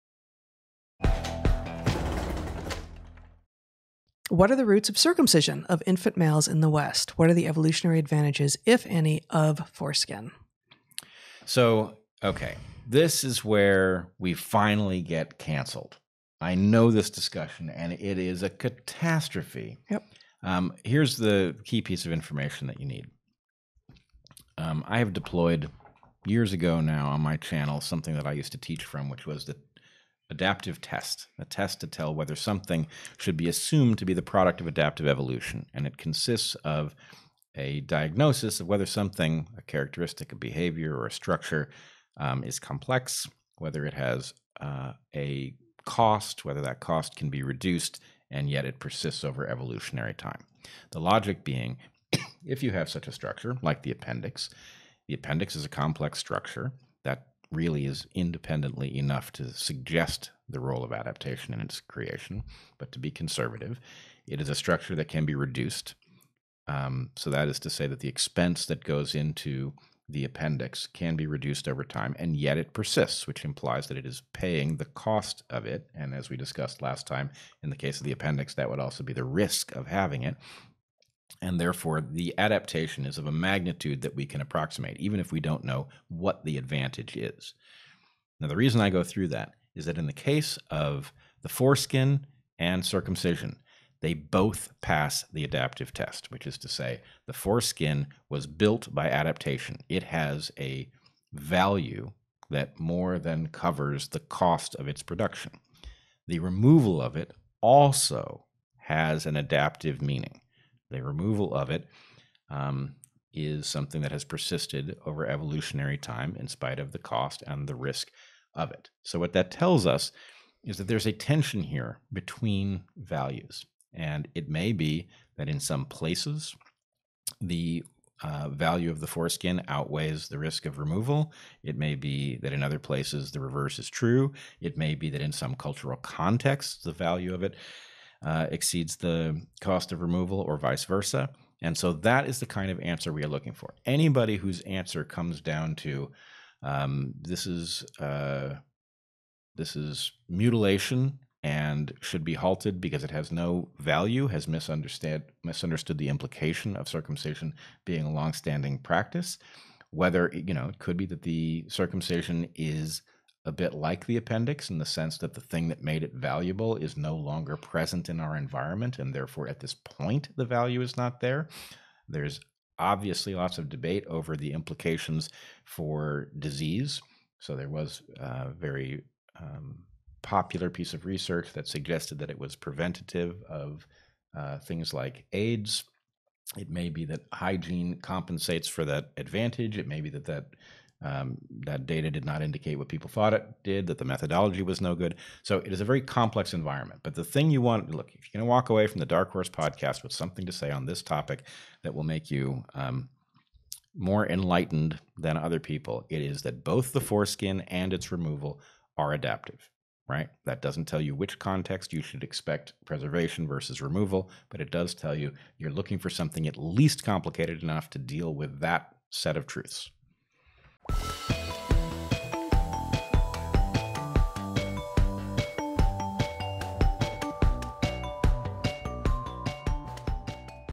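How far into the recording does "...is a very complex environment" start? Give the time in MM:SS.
03:15.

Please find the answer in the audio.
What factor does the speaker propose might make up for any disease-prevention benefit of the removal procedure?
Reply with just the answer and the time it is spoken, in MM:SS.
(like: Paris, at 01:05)
hygiene, at 03:07.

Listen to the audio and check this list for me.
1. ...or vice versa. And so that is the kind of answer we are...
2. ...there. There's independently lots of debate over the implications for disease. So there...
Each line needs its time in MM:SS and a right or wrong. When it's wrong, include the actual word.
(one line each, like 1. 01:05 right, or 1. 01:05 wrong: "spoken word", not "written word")
1. 02:20 right
2. 02:51 wrong: "obviously", not "independently".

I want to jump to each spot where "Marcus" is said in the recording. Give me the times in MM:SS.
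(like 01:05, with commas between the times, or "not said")
not said.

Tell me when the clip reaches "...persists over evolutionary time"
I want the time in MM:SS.
00:48.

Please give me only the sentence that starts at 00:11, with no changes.
So, okay, this is where we finally get canceled.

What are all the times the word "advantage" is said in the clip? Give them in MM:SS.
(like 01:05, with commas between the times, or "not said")
00:07, 01:26, 03:09.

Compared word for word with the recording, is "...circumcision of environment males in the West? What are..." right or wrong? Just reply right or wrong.
wrong.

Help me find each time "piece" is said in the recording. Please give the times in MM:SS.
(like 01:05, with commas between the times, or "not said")
00:21, 03:00.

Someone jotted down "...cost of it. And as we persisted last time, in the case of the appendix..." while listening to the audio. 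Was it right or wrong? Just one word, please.
wrong.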